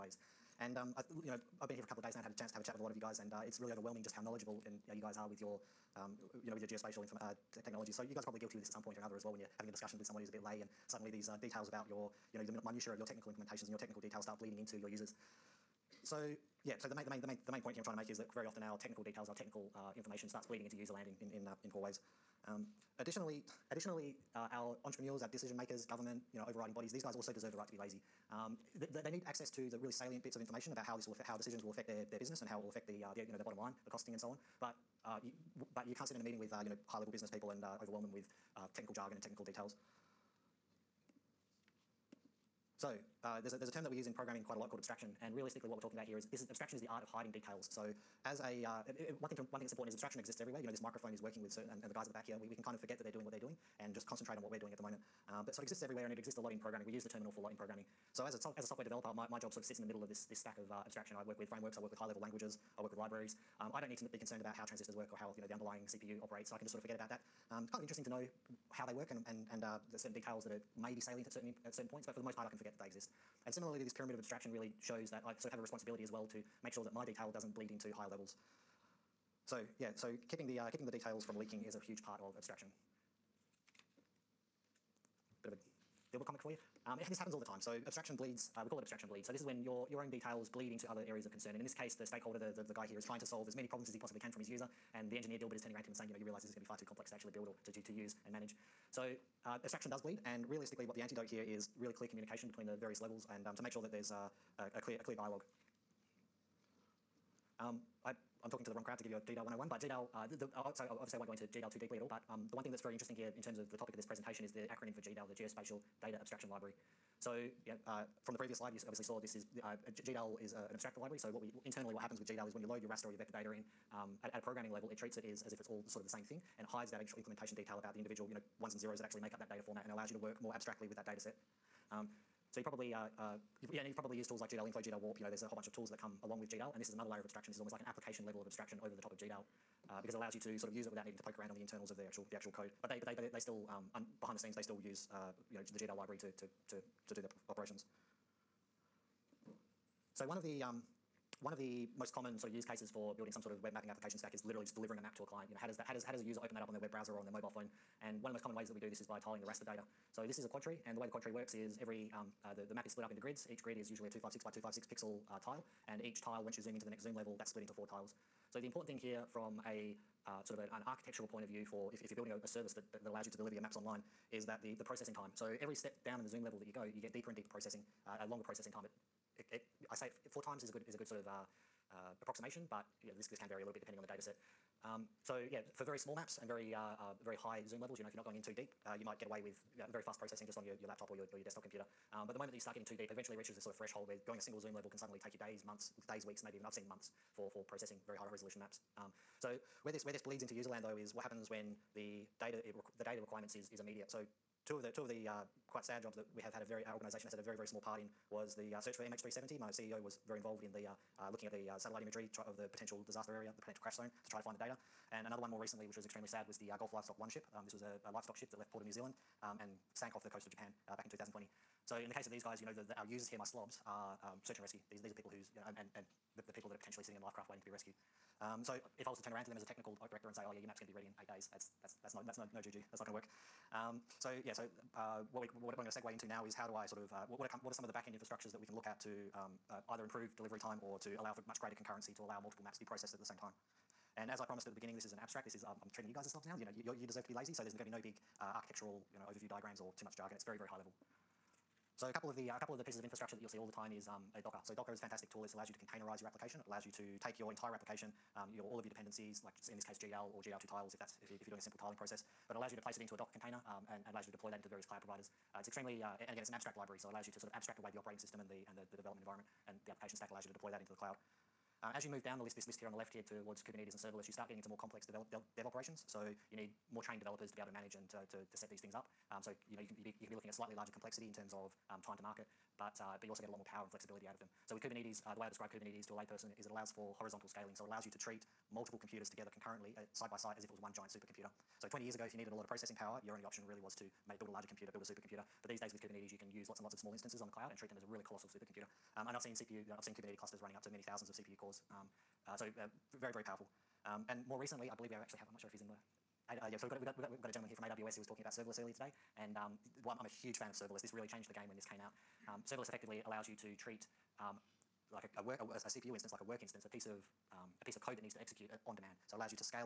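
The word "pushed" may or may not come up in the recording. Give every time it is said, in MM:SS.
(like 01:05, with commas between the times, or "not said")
not said.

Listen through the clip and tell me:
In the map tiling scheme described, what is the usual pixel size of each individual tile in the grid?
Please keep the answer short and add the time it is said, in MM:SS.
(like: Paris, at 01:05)
256 by 256, at 02:44.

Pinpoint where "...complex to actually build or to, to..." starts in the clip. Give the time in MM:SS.
01:36.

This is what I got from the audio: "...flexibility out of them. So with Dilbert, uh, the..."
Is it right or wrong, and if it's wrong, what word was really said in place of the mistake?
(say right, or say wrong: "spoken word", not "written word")
wrong: "Kubernetes", not "Dilbert".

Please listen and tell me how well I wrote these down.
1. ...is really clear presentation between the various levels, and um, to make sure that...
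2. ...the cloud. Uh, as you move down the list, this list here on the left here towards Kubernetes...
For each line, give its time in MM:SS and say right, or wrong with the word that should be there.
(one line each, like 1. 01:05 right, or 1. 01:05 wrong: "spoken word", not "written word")
1. 01:41 wrong: "communication", not "presentation"
2. 04:30 right.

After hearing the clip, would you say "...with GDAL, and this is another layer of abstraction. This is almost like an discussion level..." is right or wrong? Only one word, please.
wrong.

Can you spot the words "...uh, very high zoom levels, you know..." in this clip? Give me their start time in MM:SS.
03:06.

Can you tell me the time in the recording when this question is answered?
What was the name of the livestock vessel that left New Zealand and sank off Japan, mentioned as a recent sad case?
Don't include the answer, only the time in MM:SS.
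03:36.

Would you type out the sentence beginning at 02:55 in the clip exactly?
So every step down in the zoom level that you go, you get deeper and deeper processing, uh, a longer processing time.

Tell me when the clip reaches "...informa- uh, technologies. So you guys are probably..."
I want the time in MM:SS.
00:07.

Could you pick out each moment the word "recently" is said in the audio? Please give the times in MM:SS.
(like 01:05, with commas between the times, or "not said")
03:35, 05:04.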